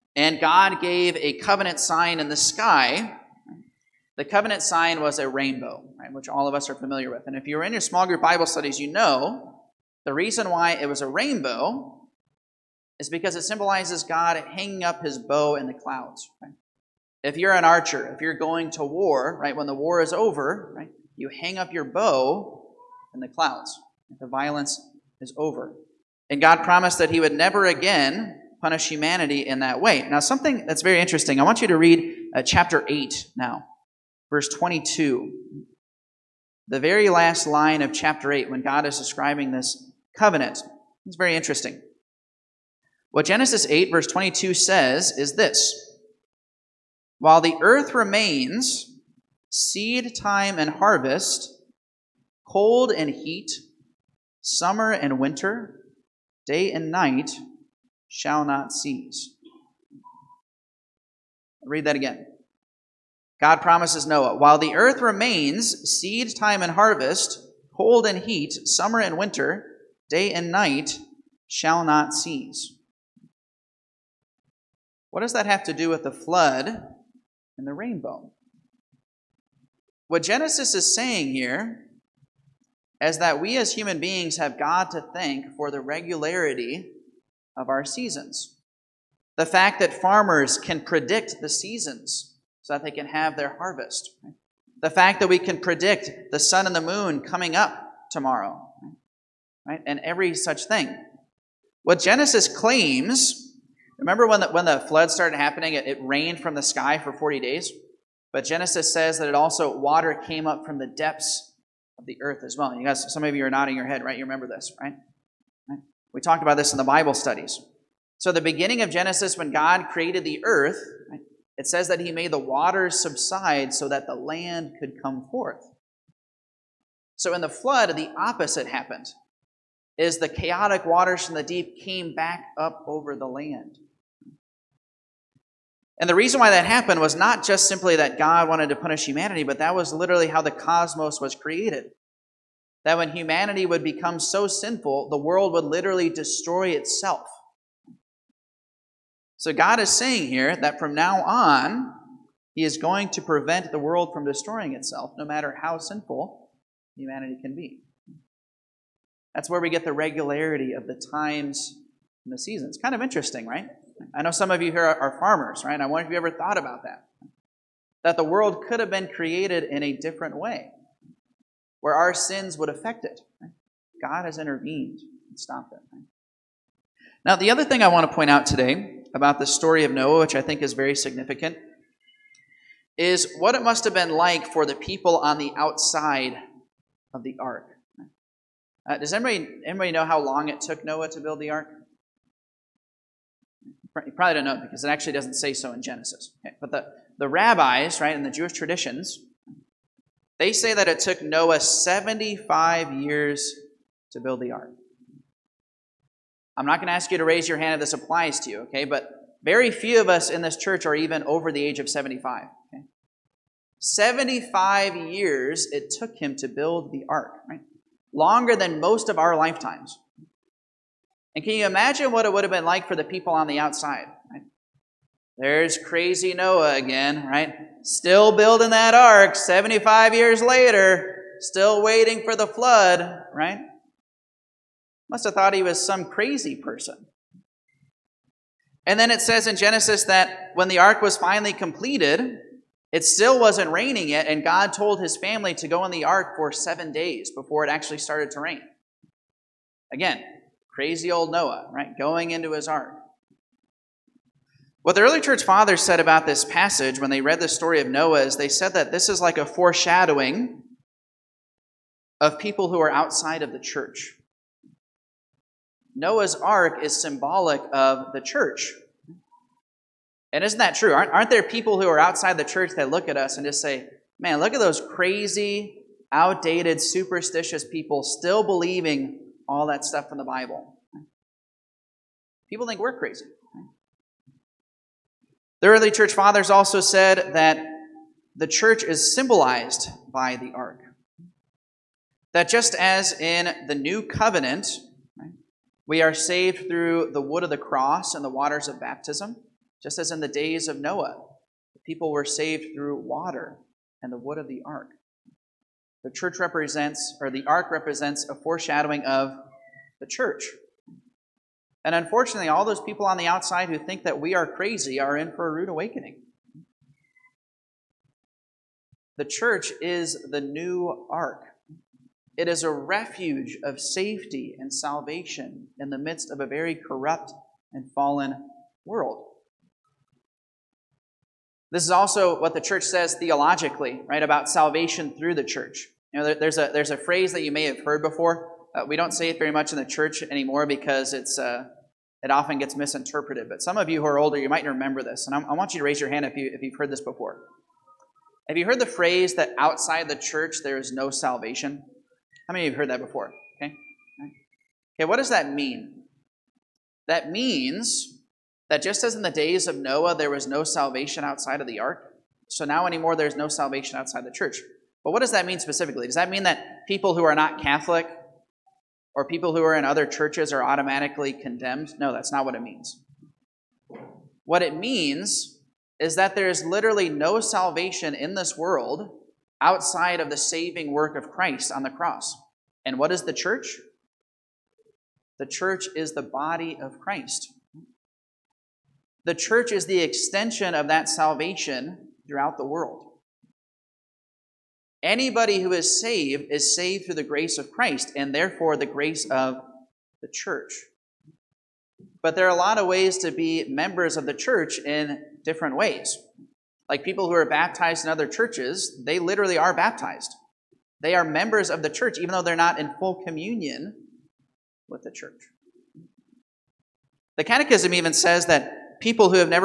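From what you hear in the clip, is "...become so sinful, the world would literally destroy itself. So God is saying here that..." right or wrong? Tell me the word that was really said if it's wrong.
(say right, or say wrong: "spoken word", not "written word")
right.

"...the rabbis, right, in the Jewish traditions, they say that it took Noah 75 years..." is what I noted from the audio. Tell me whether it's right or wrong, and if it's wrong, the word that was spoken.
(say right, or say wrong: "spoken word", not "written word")
right.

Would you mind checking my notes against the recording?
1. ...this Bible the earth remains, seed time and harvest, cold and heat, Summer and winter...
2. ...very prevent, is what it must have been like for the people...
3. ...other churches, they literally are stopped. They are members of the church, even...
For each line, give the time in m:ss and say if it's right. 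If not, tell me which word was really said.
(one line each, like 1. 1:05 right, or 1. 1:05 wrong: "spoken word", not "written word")
1. 0:45 wrong: "While", not "Bible"
2. 3:00 wrong: "significant", not "prevent"
3. 6:48 wrong: "baptized", not "stopped".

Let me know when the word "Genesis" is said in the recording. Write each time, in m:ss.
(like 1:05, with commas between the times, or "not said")
0:43, 1:20, 1:42, 1:48, 1:58, 3:15, 3:59.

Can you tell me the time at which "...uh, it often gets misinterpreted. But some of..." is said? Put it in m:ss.
5:41.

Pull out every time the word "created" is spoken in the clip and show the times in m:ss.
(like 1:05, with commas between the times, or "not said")
1:59, 2:21, 2:49.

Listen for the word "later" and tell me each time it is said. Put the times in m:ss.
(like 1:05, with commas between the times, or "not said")
3:50.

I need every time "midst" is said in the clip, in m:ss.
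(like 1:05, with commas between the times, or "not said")
5:25.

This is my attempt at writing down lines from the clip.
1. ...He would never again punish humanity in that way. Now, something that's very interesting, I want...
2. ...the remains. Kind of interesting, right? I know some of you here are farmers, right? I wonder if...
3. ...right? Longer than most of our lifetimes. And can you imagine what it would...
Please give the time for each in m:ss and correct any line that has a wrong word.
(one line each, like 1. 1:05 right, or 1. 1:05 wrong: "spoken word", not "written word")
1. 0:27 right
2. 2:42 wrong: "seasons", not "remains"
3. 3:37 right.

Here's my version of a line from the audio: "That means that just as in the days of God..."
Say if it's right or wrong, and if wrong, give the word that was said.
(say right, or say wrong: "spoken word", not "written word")
wrong: "Noah", not "God".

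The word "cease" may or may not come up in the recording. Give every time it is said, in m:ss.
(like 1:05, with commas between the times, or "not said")
0:58, 1:12.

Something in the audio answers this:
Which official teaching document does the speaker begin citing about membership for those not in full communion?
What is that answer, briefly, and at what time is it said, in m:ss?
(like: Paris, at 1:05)
The Catechism, at 6:57.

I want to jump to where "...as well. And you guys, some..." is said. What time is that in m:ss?
1:52.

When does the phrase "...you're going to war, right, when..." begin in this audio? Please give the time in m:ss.
0:18.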